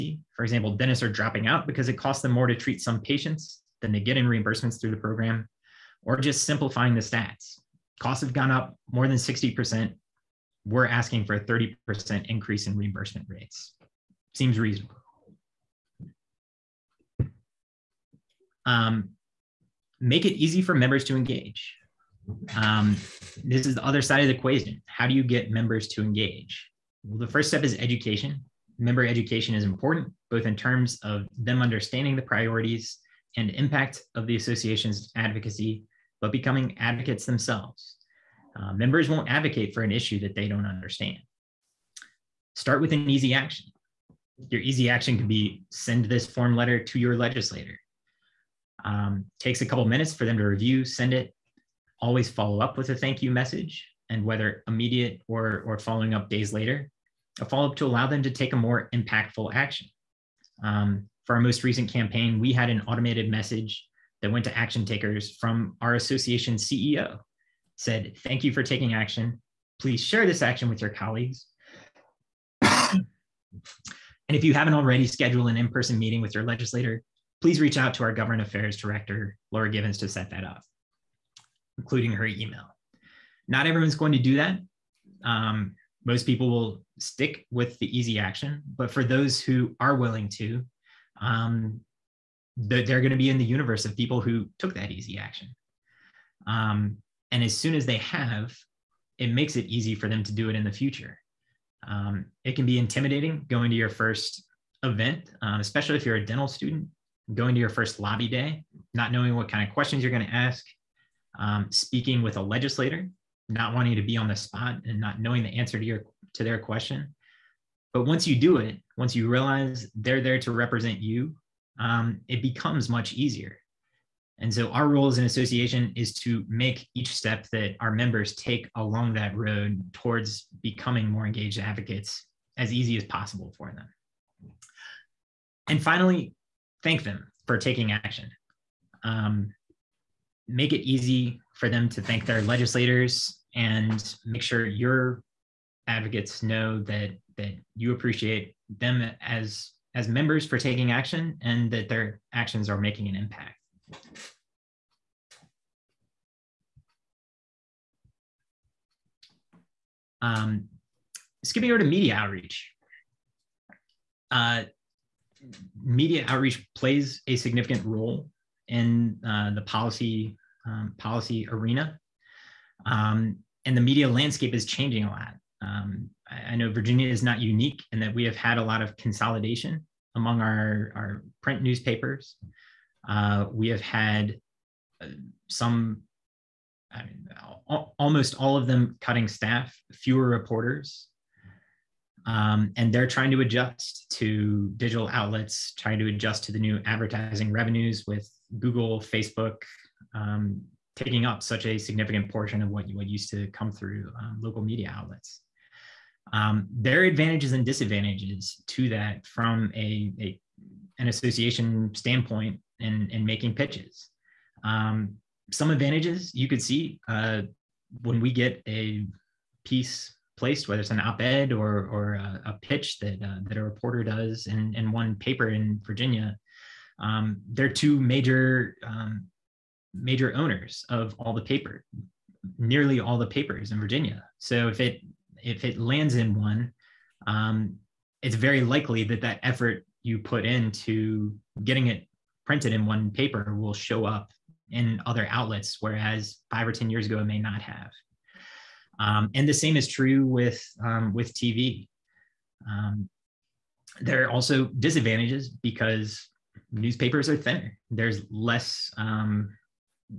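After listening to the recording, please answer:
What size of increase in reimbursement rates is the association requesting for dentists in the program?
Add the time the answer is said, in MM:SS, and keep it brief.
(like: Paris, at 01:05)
30%, at 00:11.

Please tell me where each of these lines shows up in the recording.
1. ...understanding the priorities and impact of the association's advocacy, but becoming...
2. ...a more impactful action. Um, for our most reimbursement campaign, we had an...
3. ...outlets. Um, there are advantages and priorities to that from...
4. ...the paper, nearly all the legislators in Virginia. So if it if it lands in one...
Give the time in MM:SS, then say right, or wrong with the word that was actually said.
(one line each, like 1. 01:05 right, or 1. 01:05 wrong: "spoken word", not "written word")
1. 00:31 right
2. 00:58 wrong: "recent", not "reimbursement"
3. 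03:24 wrong: "disadvantages", not "priorities"
4. 03:51 wrong: "papers", not "legislators".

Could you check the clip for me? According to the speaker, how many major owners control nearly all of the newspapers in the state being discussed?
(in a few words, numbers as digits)
2.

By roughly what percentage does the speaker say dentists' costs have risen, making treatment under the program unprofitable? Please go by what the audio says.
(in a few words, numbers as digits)
60%.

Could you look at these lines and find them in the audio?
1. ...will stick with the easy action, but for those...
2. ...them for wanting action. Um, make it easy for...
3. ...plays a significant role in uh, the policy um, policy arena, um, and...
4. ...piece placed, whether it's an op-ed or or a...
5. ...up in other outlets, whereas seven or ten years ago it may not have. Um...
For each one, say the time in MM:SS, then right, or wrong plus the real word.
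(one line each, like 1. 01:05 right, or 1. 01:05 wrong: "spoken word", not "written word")
1. 01:26 right
2. 02:17 wrong: "taking", not "wanting"
3. 02:46 right
4. 03:39 right
5. 04:04 wrong: "five", not "seven".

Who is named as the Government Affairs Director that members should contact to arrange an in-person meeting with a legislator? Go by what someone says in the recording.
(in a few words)
Laura Givens.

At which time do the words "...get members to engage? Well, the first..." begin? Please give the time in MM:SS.
00:25.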